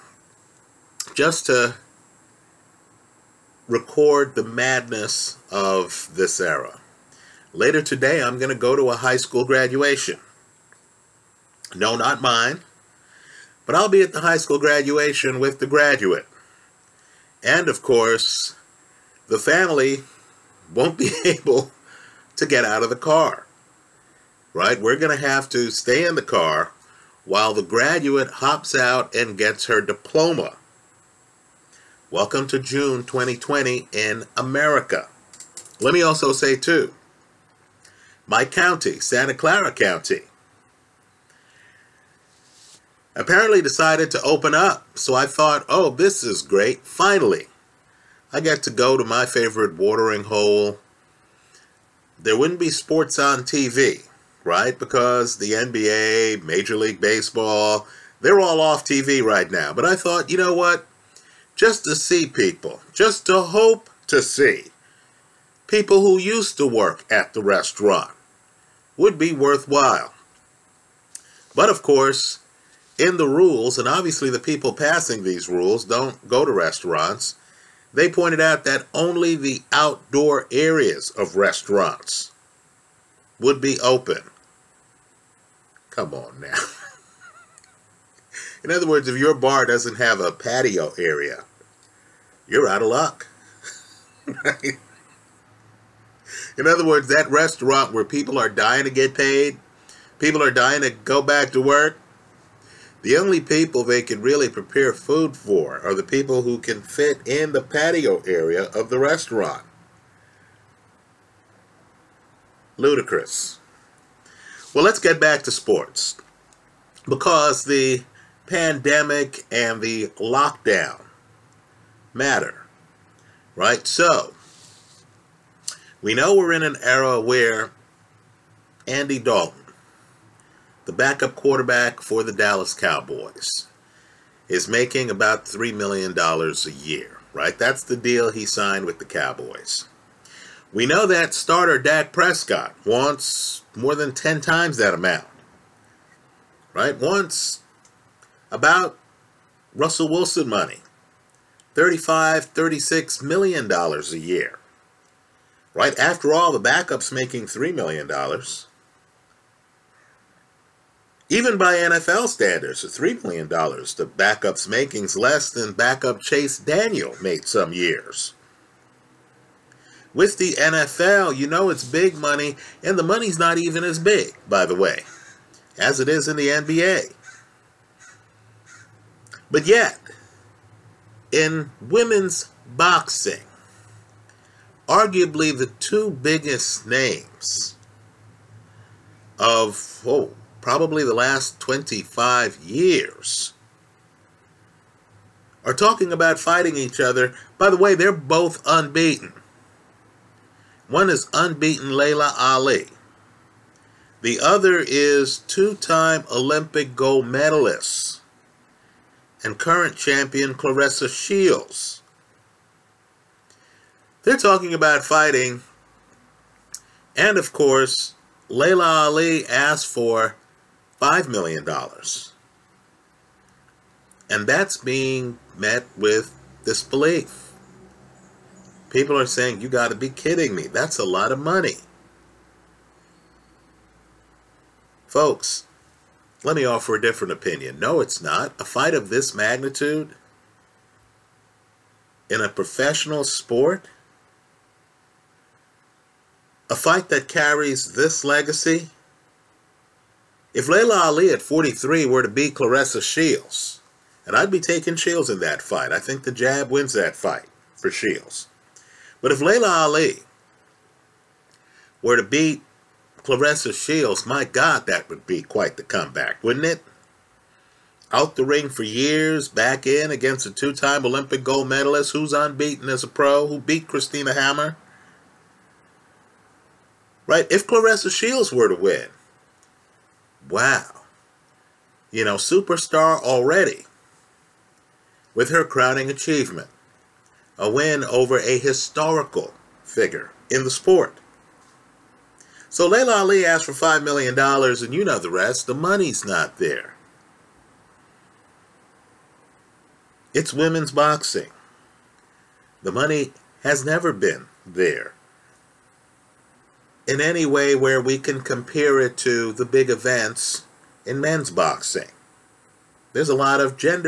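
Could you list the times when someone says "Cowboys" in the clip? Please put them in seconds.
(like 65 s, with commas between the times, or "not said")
132 s, 139 s.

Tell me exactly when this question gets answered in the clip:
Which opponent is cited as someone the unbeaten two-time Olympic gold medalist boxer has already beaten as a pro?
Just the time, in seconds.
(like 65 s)
273 s.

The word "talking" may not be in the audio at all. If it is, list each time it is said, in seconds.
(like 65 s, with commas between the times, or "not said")
195 s, 214 s.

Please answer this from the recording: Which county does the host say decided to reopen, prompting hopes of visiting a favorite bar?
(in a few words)
Santa Clara County.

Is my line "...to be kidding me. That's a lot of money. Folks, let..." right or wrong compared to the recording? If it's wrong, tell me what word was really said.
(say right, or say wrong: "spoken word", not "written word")
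right.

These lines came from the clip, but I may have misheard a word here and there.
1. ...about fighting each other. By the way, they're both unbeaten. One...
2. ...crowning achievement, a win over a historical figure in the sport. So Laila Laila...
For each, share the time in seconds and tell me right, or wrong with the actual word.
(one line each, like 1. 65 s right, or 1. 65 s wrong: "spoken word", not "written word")
1. 196 s right
2. 285 s wrong: "Ali", not "Laila".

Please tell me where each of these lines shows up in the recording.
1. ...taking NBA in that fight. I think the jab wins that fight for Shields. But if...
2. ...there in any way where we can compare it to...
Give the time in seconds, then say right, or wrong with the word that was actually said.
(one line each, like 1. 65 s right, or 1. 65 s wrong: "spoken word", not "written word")
1. 254 s wrong: "Shields", not "NBA"
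2. 304 s right.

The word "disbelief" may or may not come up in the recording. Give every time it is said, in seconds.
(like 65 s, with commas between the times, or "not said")
226 s.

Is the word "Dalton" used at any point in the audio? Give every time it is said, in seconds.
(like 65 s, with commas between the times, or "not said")
129 s.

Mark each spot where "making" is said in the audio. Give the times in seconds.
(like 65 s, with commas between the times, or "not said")
134 s, 157 s, 164 s.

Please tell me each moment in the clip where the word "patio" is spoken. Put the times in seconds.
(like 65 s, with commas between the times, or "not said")
90 s, 107 s.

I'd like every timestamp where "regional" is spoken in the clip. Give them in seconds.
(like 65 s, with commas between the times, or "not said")
not said.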